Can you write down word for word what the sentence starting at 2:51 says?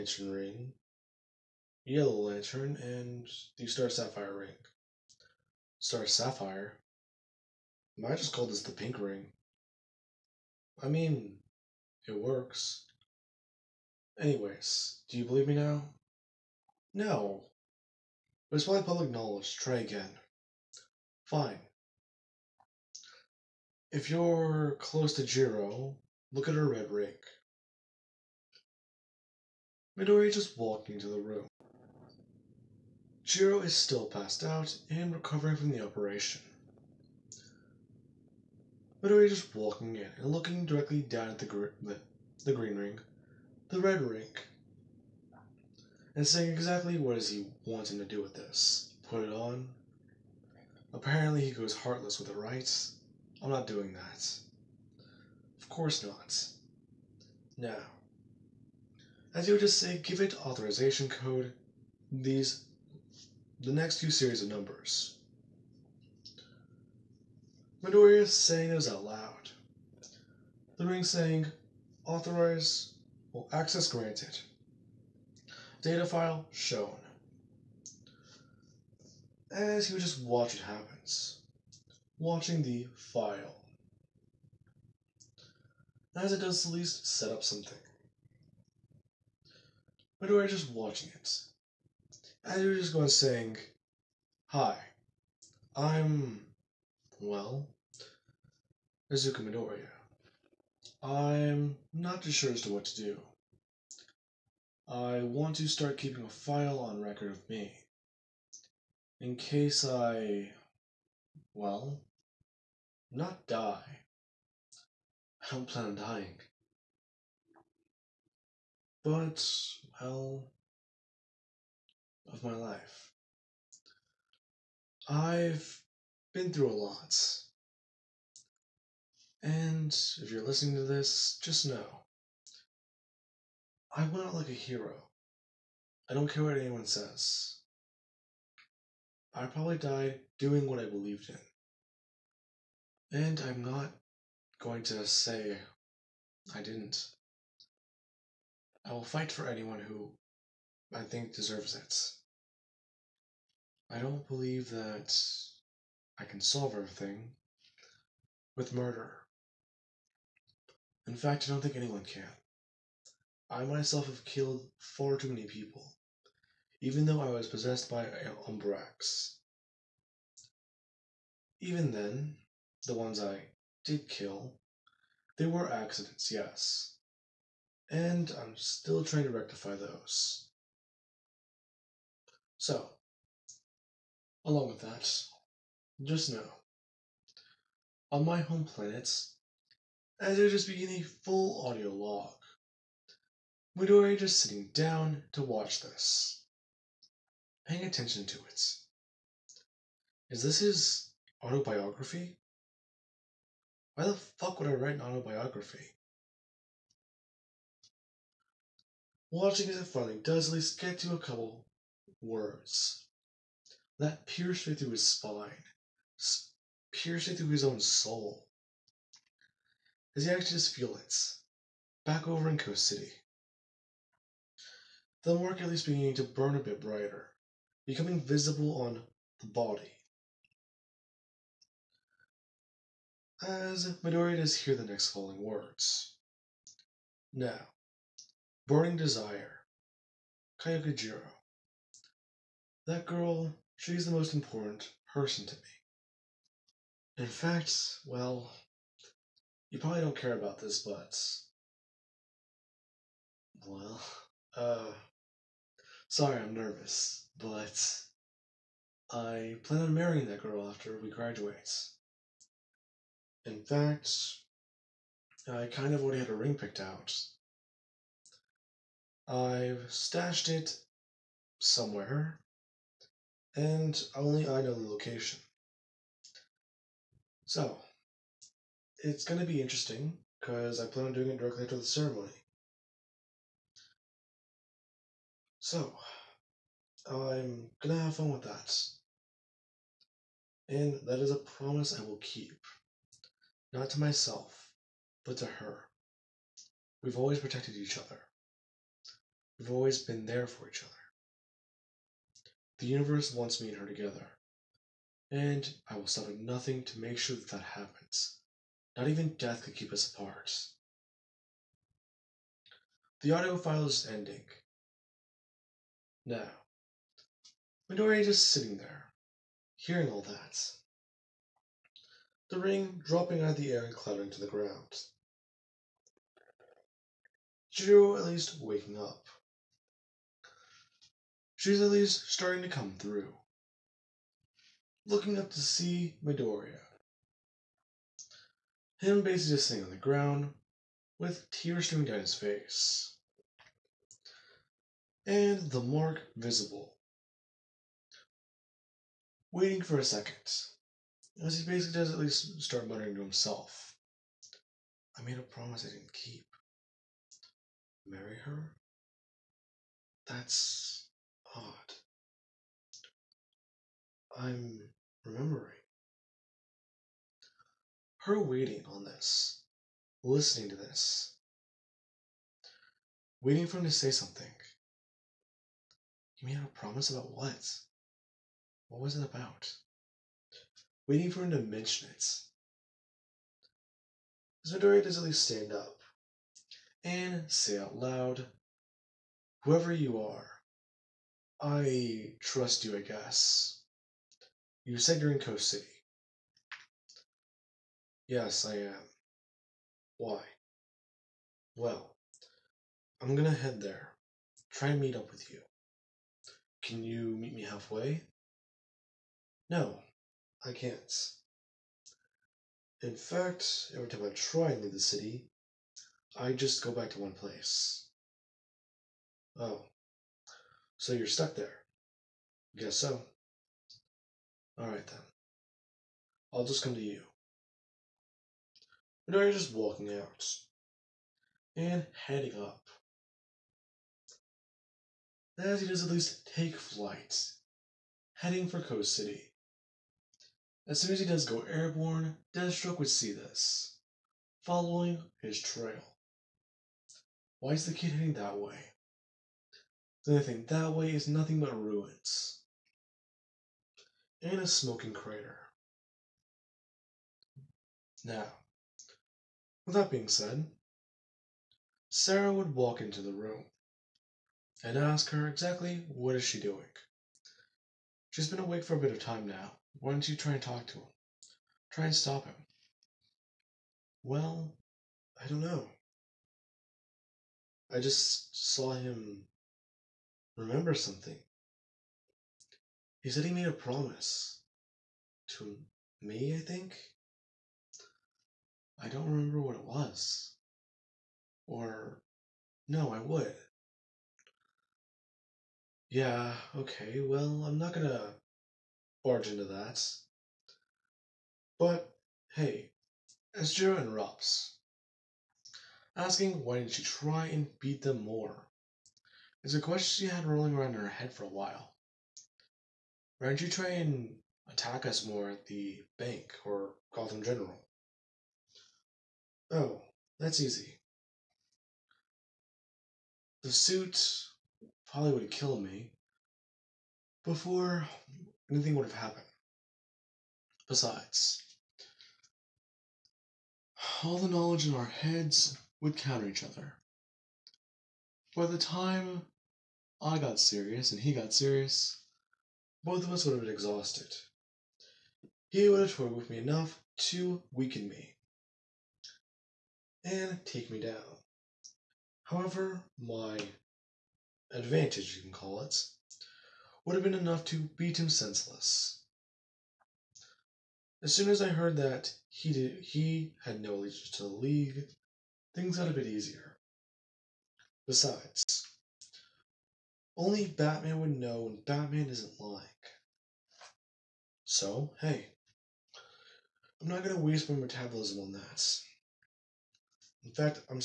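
Even then, the ones I did kill, they were accidents, yes.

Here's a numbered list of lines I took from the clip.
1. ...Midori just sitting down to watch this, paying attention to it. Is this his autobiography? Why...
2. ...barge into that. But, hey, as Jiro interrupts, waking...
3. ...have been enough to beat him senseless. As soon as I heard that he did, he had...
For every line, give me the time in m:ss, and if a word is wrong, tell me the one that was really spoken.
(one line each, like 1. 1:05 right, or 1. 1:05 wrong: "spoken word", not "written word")
1. 3:13 right
2. 8:19 wrong: "asking", not "waking"
3. 9:17 right.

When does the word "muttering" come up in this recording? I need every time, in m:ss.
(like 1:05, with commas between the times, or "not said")
5:52.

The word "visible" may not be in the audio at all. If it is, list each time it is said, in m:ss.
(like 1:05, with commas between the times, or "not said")
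3:48, 5:46.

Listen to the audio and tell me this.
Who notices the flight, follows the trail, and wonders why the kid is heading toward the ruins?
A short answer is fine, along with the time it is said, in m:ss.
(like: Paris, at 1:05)
Deathstroke, at 7:22.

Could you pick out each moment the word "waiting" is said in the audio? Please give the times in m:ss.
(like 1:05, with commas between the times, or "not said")
5:49, 6:08, 6:13, 6:21.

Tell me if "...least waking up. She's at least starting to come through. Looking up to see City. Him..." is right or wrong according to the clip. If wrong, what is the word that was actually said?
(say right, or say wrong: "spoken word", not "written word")
wrong: "Midoriya", not "City".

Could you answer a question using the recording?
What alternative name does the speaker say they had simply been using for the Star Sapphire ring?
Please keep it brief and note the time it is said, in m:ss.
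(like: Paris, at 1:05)
The pink ring, at 0:08.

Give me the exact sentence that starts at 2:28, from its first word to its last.
I will fight for anyone who I think deserves it.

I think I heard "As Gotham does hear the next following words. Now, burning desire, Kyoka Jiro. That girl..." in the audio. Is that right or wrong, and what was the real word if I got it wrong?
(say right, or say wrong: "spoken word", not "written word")
wrong: "Midori", not "Gotham".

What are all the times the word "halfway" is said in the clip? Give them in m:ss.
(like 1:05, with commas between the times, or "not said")
6:47.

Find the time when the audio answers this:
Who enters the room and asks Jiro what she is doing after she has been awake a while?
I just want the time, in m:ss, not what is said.
7:42.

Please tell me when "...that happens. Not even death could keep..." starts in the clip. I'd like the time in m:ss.
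5:07.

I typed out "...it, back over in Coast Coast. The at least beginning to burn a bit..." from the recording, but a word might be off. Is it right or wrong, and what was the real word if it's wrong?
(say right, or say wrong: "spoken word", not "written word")
wrong: "City", not "Coast".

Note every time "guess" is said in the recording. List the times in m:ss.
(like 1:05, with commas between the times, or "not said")
6:33, 7:02.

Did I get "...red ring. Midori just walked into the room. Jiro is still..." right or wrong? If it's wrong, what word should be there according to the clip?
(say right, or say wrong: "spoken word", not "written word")
right.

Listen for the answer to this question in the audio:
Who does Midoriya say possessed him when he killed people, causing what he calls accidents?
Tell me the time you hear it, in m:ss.
2:48.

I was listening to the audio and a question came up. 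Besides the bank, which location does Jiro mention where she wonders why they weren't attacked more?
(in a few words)
Gotham General.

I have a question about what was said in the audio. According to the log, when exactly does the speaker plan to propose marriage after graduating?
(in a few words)
Directly after the ceremony.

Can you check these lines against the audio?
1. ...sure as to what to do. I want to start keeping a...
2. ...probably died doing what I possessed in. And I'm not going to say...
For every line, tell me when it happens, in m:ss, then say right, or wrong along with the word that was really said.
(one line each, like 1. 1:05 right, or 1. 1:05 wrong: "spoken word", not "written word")
1. 1:42 right
2. 2:19 wrong: "believed", not "possessed".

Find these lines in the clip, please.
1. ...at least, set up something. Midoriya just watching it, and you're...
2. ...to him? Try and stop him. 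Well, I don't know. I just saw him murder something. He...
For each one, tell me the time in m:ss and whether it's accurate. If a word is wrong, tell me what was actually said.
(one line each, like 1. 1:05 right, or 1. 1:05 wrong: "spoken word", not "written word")
1. 1:26 right
2. 7:50 wrong: "remember", not "murder".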